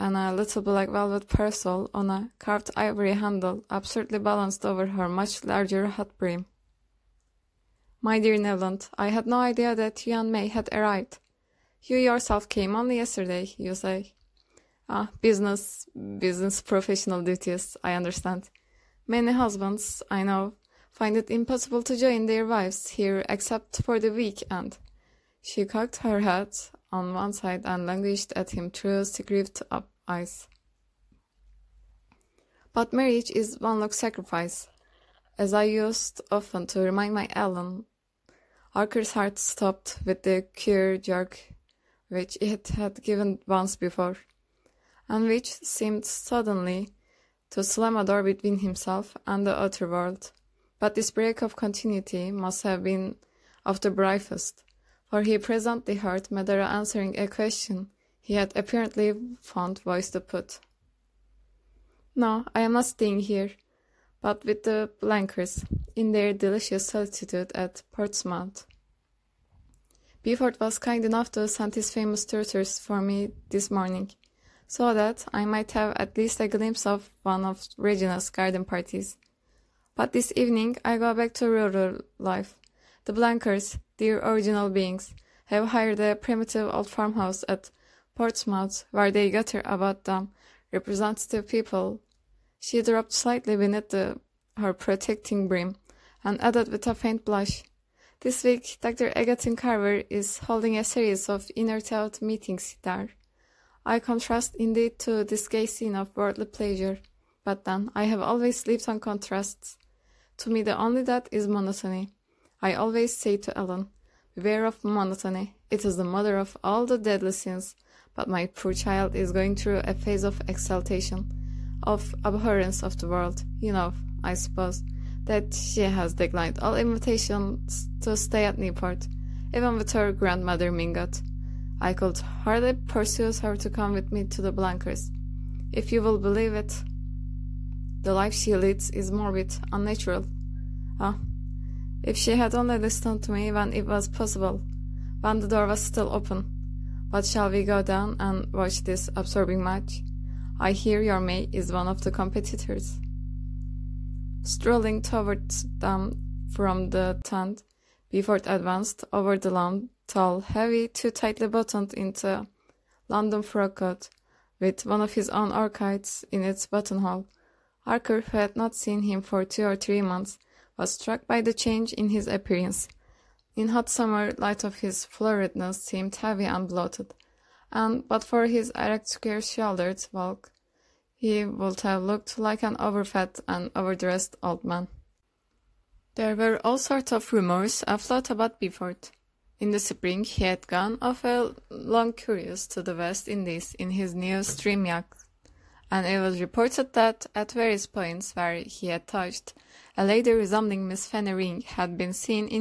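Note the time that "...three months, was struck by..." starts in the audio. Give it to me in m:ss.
2:49.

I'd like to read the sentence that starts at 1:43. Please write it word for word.
I contrast indeed to this gay scene of worldly pleasure, but then I have always lived on contrasts.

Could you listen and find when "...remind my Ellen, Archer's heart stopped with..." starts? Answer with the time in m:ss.
0:36.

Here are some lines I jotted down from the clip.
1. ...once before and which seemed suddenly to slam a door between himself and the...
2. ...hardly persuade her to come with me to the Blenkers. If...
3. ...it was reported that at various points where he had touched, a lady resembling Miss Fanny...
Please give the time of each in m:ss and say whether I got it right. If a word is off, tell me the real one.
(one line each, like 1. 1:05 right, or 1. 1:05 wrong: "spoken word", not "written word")
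1. 0:43 right
2. 2:12 right
3. 3:16 right.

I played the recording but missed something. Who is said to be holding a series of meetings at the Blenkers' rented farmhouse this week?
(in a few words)
Dr. Egerton Carver.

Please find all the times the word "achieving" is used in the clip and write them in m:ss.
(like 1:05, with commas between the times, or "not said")
not said.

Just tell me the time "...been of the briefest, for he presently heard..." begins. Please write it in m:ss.
0:52.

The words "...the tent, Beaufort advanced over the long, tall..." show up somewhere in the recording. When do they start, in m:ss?
2:36.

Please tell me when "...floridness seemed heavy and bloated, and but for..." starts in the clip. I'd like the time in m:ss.
2:55.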